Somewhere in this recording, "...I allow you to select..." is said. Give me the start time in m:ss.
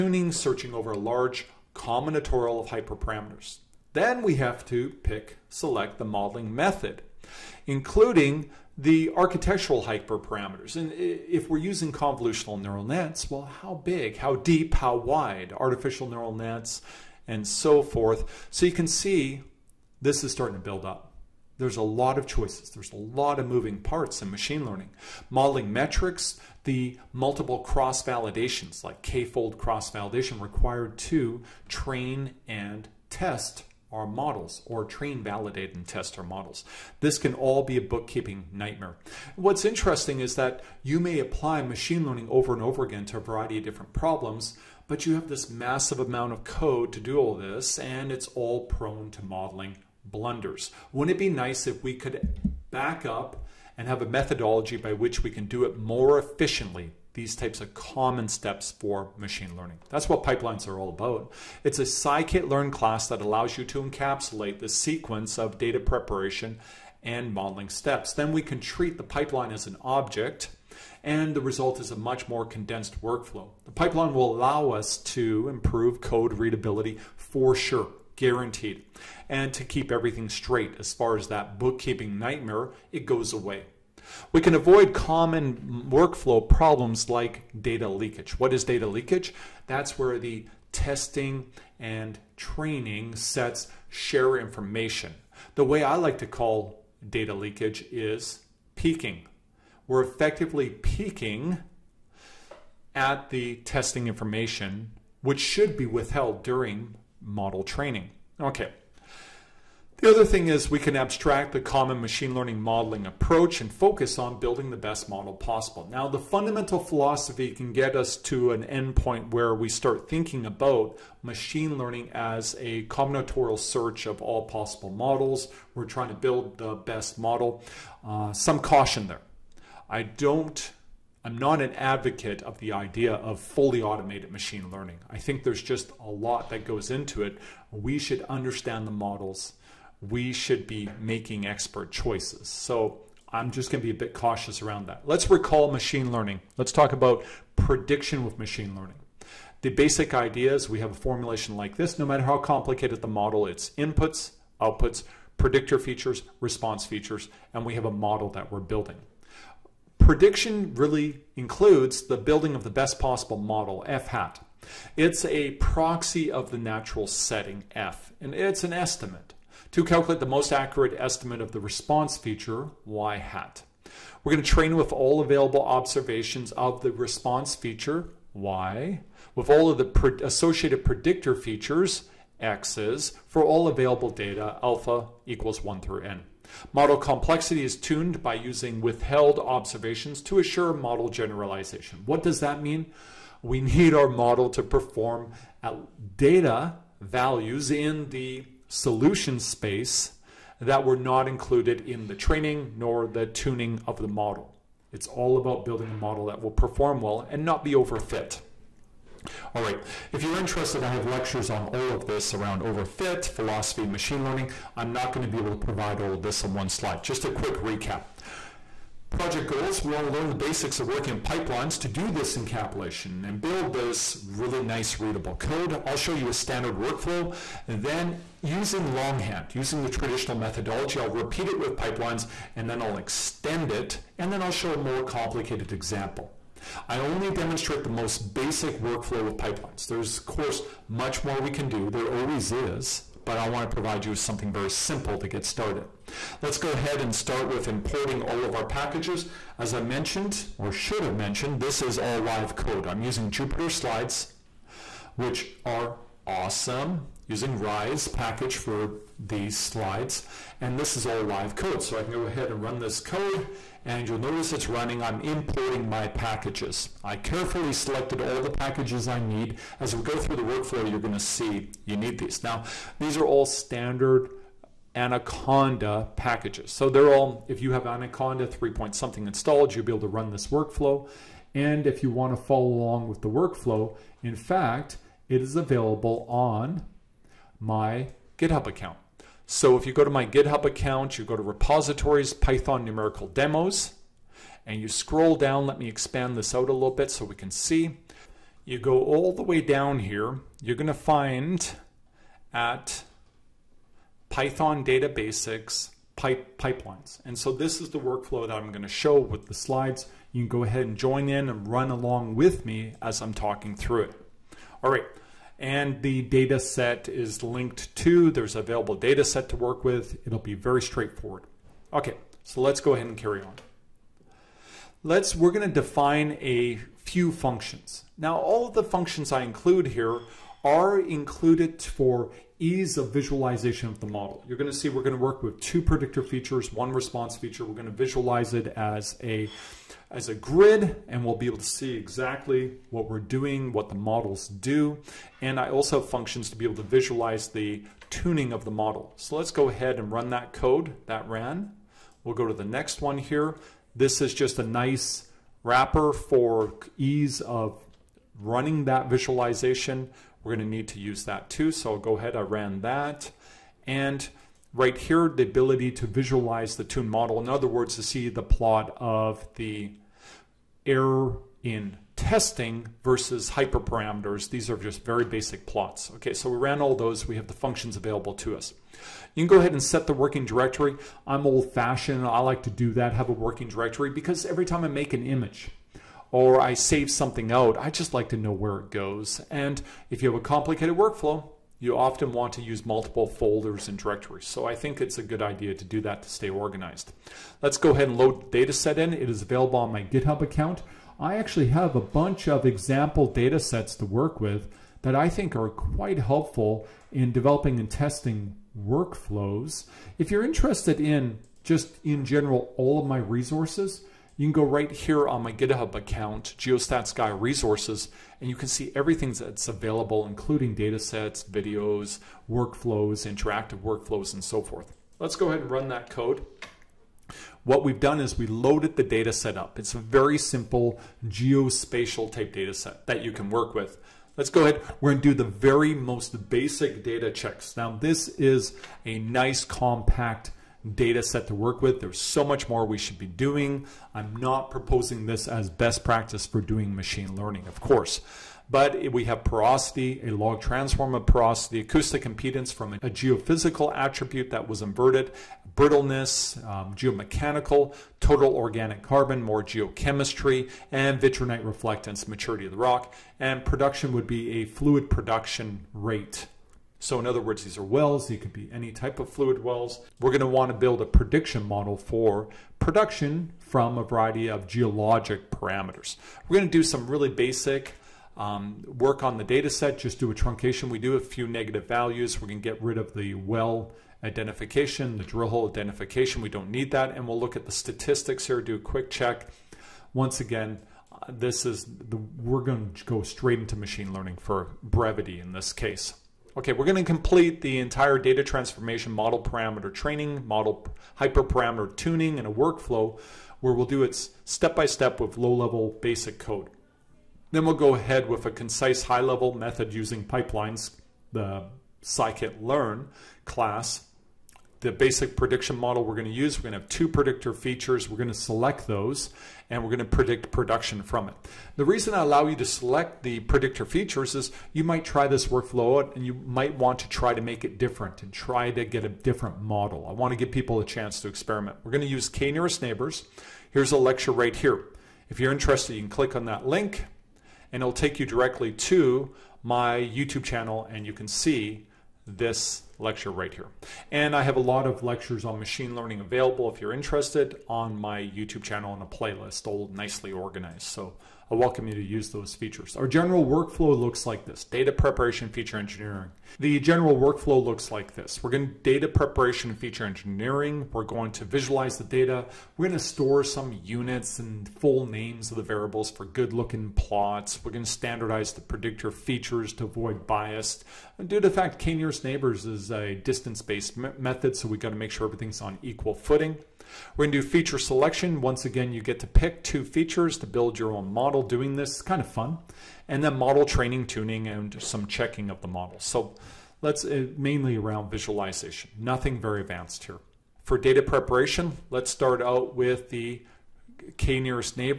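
8:42.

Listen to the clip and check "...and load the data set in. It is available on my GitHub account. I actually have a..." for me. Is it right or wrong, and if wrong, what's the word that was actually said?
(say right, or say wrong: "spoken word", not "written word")
right.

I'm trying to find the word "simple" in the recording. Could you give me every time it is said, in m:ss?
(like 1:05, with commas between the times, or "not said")
4:04, 7:10.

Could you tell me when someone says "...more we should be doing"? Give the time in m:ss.
7:22.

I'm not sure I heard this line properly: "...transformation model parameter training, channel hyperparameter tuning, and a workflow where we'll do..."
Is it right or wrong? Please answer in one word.
wrong.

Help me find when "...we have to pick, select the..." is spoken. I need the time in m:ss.
0:04.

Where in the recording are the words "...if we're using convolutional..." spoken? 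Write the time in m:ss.
0:10.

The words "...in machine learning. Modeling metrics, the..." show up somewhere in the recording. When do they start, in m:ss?
0:24.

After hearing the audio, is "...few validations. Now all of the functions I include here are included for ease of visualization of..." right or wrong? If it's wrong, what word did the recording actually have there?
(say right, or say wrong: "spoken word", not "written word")
wrong: "functions", not "validations".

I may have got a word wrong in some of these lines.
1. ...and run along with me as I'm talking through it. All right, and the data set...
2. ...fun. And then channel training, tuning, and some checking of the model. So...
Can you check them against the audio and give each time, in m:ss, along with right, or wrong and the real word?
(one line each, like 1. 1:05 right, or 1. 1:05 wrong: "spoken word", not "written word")
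1. 5:11 right
2. 9:42 wrong: "model", not "channel".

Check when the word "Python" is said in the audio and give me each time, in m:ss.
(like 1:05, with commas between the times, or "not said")
4:52, 5:04.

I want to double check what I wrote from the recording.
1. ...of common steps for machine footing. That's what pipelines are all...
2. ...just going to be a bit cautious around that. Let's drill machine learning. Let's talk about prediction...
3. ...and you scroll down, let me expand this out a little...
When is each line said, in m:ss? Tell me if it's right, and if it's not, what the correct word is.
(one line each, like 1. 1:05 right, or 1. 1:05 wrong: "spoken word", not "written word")
1. 0:57 wrong: "learning", not "footing"
2. 2:23 wrong: "recall", not "drill"
3. 4:54 right.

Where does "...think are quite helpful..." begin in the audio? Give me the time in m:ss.
6:45.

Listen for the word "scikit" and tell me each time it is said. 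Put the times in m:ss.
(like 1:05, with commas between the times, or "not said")
1:01, 8:32.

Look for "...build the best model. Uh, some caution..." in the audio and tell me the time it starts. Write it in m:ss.
2:06.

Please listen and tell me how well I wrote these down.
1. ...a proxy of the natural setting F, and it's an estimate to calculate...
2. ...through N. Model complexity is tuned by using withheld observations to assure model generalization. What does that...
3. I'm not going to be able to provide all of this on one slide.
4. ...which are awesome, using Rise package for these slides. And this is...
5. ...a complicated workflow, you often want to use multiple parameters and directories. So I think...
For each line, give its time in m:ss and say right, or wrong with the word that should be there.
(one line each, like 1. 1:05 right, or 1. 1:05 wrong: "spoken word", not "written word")
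1. 2:45 right
2. 3:05 right
3. 3:34 right
4. 4:15 right
5. 6:30 wrong: "folders", not "parameters".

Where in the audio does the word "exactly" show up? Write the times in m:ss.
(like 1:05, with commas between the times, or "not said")
5:41.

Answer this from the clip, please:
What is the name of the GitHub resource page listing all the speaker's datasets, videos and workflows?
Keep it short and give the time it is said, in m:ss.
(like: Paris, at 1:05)
Geostats Guy Resources, at 6:56.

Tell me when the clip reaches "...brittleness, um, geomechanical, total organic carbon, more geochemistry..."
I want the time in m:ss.
7:35.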